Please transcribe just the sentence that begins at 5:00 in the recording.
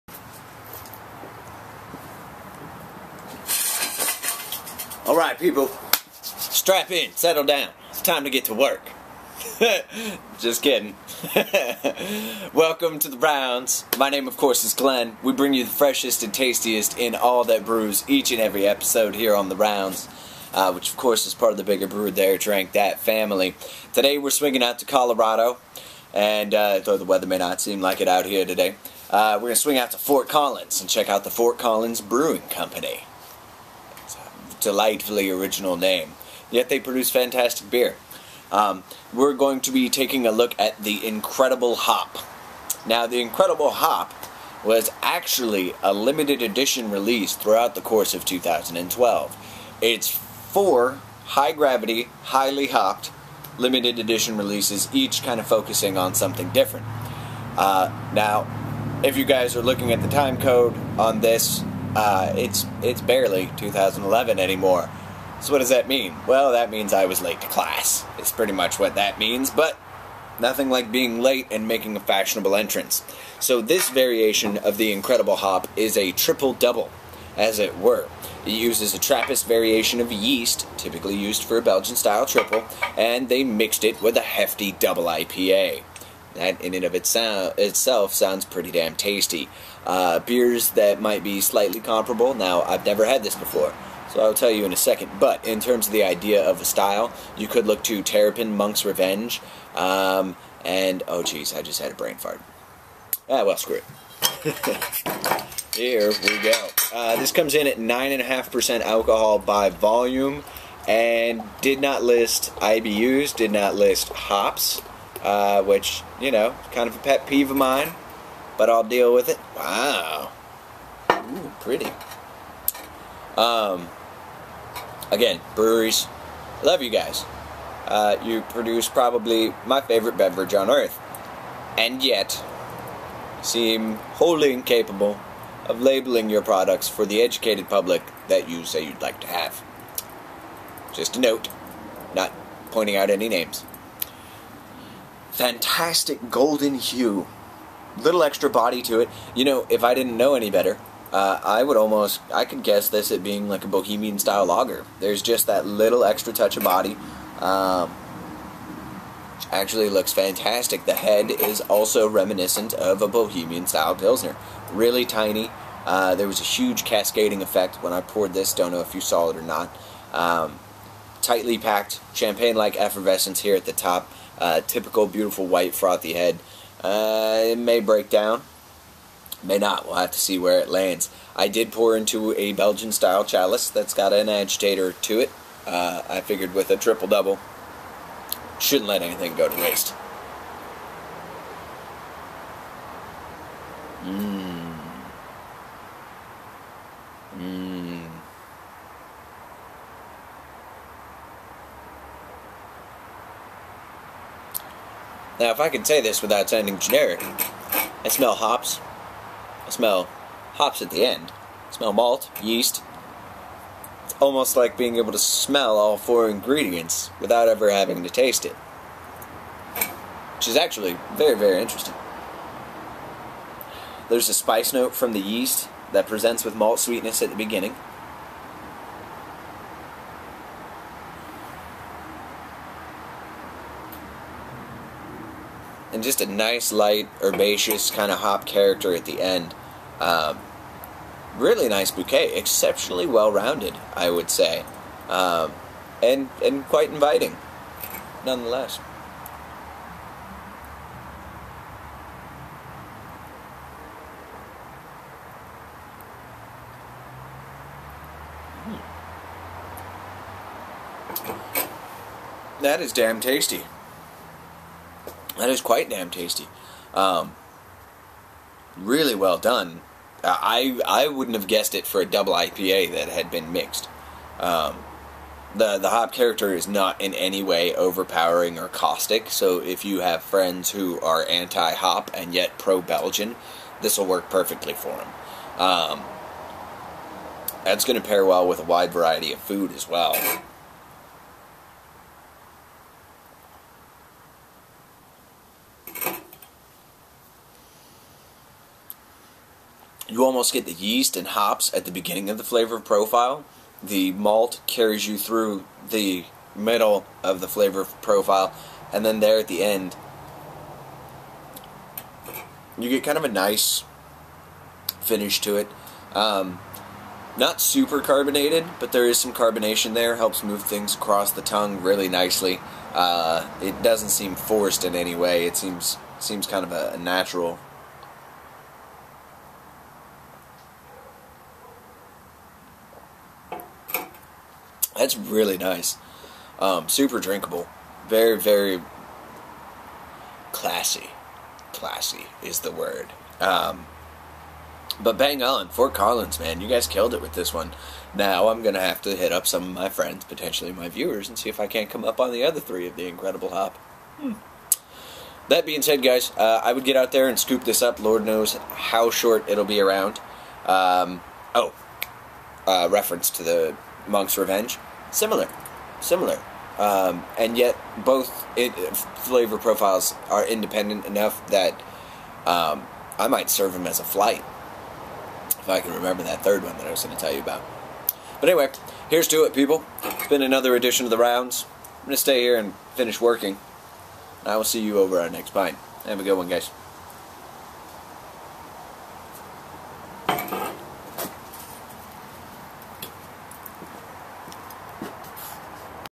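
you almost get the yeast and hops at the beginning of the flavor profile.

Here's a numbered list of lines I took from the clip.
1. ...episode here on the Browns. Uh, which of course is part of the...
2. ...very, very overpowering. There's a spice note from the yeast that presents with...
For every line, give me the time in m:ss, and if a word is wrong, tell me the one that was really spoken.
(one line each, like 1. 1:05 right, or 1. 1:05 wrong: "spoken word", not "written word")
1. 0:18 right
2. 3:41 wrong: "interesting", not "overpowering".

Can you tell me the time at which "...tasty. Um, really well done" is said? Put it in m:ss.
4:26.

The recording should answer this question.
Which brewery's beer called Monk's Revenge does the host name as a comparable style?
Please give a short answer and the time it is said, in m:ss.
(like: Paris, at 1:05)
Terrapin, at 1:38.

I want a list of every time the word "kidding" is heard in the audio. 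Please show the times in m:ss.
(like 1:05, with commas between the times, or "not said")
0:10.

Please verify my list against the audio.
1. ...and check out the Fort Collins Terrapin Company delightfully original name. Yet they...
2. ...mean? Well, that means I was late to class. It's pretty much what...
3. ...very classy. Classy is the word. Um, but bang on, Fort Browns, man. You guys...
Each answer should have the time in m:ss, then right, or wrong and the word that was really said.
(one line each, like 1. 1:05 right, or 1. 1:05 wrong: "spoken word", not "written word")
1. 0:30 wrong: "Brewing", not "Terrapin"
2. 1:05 right
3. 5:38 wrong: "Collins", not "Browns".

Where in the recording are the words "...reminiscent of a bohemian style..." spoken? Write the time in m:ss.
2:42.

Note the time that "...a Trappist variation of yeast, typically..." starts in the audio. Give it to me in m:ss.
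1:18.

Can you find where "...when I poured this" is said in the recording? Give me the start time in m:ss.
2:47.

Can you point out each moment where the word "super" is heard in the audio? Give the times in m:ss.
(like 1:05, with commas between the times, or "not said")
5:17, 5:36.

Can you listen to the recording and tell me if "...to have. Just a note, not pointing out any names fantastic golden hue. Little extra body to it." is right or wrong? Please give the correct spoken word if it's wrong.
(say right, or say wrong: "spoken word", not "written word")
right.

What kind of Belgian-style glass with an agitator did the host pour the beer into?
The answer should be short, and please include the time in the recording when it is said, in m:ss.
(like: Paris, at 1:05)
chalice, at 3:03.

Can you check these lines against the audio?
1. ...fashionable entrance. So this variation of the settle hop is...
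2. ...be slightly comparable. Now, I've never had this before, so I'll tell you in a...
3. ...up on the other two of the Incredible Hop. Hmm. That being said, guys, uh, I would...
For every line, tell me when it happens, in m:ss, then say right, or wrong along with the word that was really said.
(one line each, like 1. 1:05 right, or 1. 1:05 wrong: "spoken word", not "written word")
1. 1:11 wrong: "incredible", not "settle"
2. 1:31 right
3. 5:52 wrong: "three", not "two".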